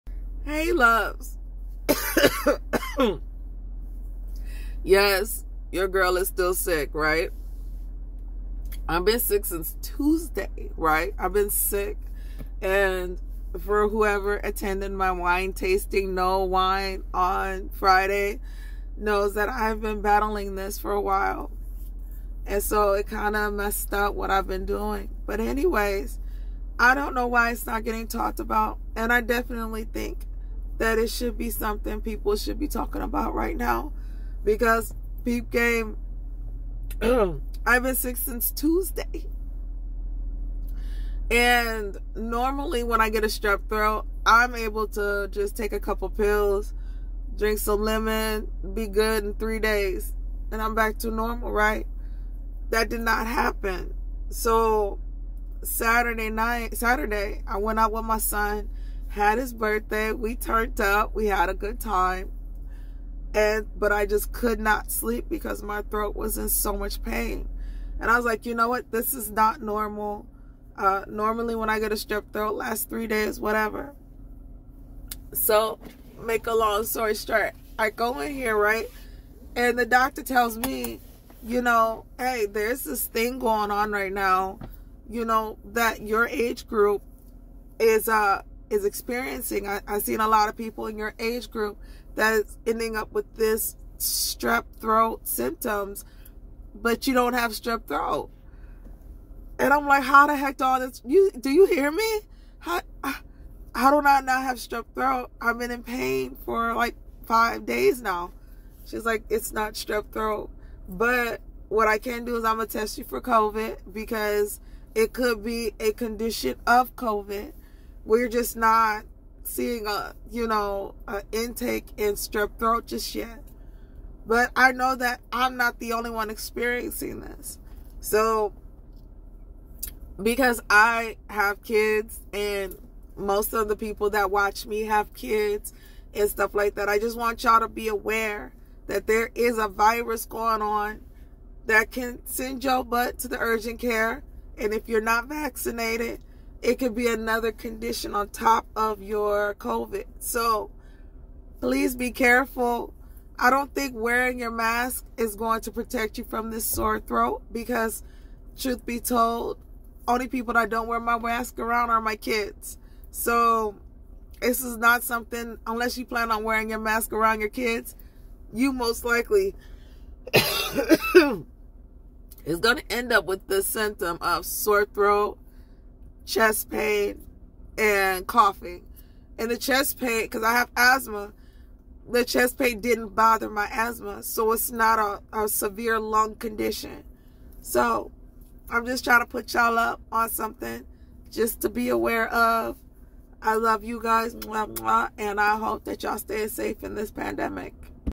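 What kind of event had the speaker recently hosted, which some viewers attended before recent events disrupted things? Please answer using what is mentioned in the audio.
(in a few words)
wine tasting.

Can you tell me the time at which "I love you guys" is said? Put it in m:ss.
3:13.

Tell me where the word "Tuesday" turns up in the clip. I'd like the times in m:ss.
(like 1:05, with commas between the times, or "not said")
0:09, 0:38.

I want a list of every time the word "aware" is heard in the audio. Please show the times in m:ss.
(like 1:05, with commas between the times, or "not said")
2:17, 3:11.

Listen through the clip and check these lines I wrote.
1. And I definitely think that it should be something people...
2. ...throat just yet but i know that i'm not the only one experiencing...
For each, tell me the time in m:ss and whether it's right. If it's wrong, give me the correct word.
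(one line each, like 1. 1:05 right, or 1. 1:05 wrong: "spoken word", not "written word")
1. 0:28 right
2. 2:02 right.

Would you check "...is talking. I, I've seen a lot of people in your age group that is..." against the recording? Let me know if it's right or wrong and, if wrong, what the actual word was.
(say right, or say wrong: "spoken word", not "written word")
wrong: "experiencing", not "talking".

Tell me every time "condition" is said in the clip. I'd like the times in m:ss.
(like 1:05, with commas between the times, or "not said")
1:55, 2:27, 3:06.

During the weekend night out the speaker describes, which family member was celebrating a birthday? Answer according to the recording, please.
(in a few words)
son.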